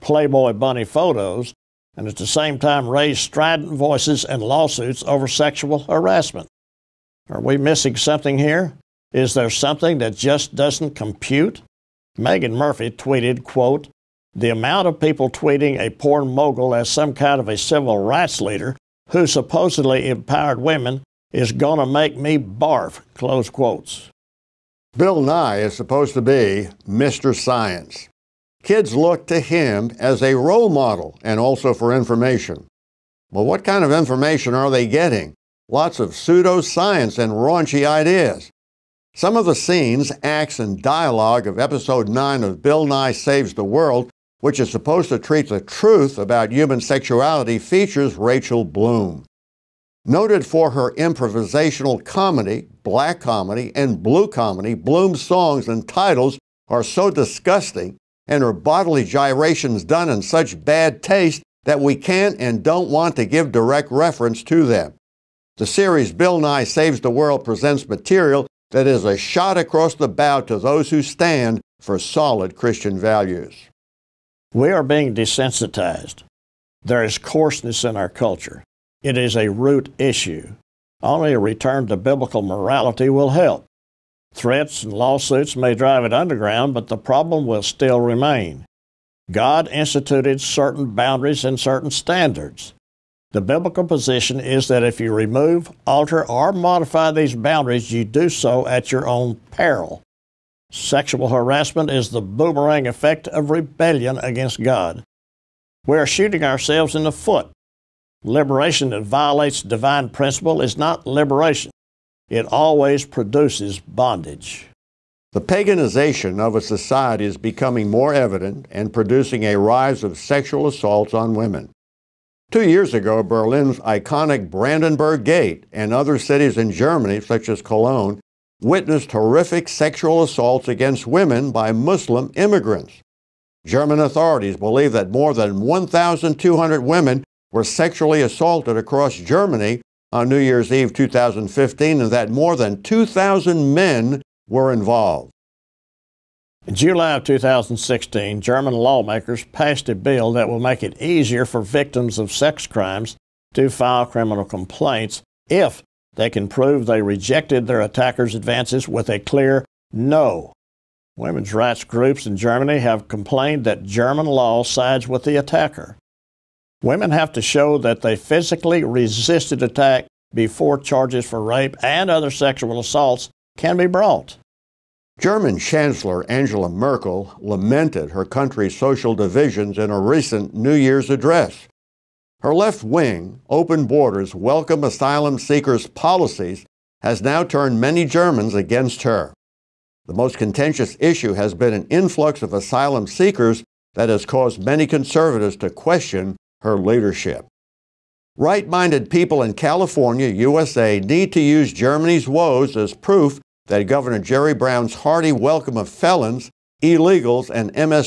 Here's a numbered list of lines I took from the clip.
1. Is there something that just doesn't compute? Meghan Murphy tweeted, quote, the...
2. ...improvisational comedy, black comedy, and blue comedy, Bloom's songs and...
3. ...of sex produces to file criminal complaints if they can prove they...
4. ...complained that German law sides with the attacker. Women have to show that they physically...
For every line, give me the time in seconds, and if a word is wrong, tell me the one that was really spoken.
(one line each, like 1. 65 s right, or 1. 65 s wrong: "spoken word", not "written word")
1. 9 s right
2. 50 s right
3. 152 s wrong: "crimes", not "produces"
4. 163 s right.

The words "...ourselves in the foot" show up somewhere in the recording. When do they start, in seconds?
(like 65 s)
106 s.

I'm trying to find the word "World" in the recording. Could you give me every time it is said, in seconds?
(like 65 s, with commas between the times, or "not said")
43 s, 67 s.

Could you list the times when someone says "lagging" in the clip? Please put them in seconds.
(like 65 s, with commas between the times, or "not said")
not said.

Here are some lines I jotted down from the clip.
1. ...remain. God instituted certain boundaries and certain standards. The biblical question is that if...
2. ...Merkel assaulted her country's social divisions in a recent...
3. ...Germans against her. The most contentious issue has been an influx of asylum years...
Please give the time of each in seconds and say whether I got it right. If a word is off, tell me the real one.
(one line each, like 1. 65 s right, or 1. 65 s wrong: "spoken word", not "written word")
1. 88 s wrong: "position", not "question"
2. 176 s wrong: "lamented", not "assaulted"
3. 188 s wrong: "seekers", not "years".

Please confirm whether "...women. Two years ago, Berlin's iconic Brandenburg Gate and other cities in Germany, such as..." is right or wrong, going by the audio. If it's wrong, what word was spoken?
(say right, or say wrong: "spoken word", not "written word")
right.